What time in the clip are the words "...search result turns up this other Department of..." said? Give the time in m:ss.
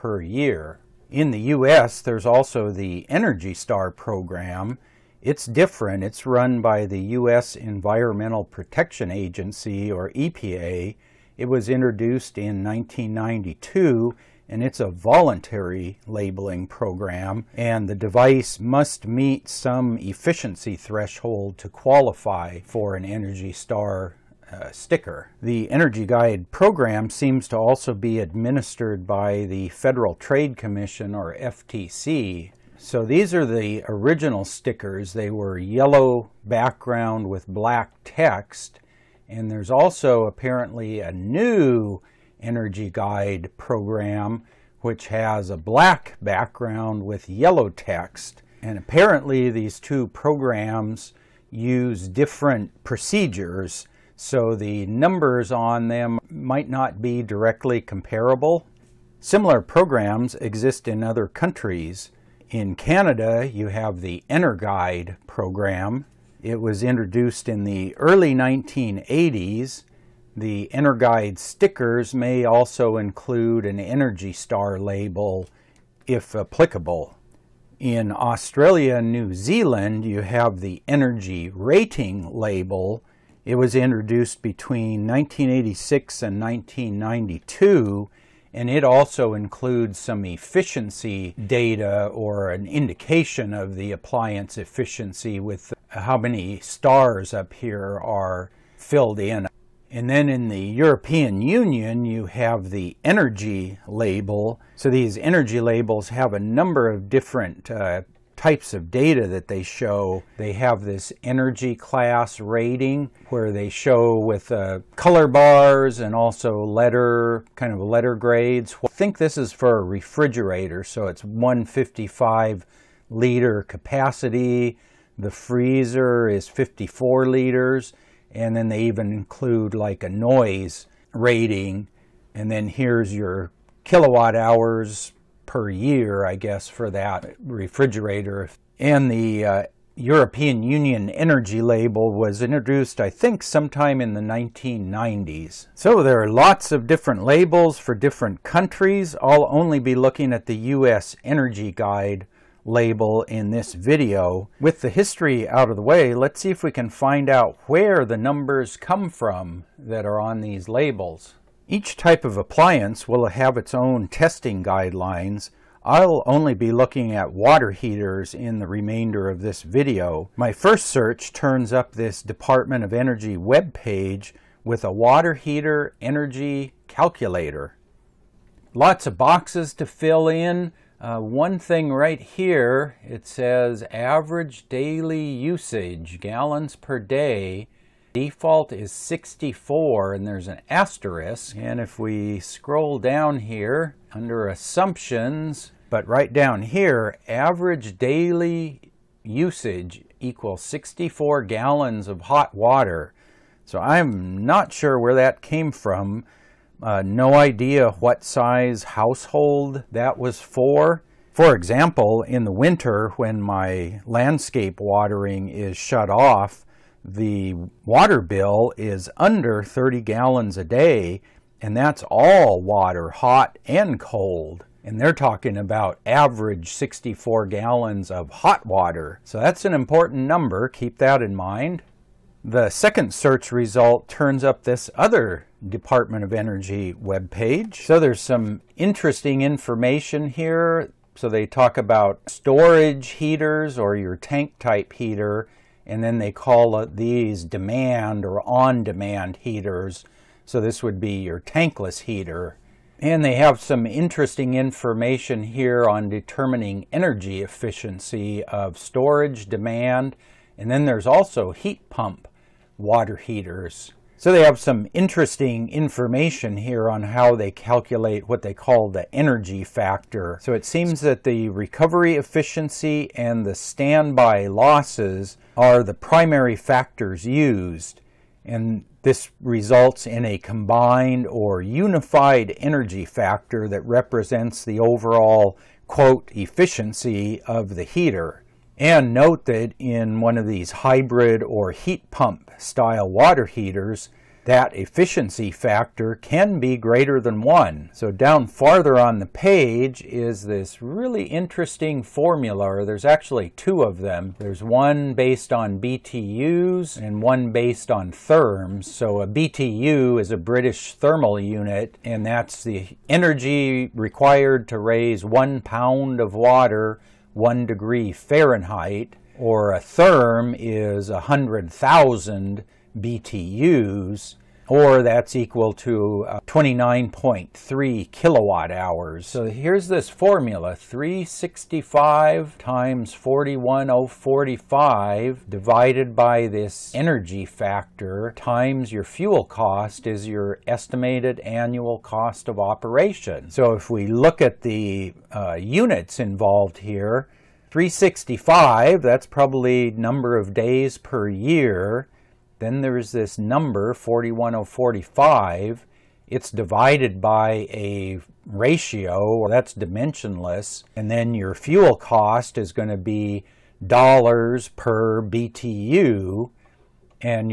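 3:53.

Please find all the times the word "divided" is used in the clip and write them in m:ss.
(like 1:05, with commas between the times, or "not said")
5:35, 5:56.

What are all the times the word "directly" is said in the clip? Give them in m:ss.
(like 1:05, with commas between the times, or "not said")
0:57.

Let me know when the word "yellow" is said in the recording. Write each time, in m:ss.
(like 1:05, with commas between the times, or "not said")
0:35, 0:47.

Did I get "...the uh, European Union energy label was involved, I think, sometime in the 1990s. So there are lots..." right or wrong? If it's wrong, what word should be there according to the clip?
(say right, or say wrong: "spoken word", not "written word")
wrong: "introduced", not "involved".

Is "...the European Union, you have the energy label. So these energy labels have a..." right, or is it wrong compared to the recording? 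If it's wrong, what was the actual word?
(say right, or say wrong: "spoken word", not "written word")
right.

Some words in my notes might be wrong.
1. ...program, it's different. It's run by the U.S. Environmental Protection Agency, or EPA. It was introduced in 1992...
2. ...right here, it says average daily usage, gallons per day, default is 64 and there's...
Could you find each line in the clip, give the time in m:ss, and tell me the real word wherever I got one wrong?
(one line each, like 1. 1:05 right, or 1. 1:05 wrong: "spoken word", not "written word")
1. 0:03 right
2. 3:01 right.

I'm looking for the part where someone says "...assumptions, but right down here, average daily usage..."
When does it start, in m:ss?
3:14.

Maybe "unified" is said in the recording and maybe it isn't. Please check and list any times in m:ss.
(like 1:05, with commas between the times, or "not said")
4:41.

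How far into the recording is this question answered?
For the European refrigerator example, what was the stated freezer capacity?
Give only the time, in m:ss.
2:06.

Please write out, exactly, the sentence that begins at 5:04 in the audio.
There's one based on BTUs and one based on therms.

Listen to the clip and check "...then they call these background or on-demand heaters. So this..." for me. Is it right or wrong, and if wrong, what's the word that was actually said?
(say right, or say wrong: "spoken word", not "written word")
wrong: "demand", not "background".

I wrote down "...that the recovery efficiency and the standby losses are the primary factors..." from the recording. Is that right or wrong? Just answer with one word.
right.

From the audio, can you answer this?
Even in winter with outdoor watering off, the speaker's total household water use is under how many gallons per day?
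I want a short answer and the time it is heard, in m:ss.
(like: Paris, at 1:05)
30, at 3:39.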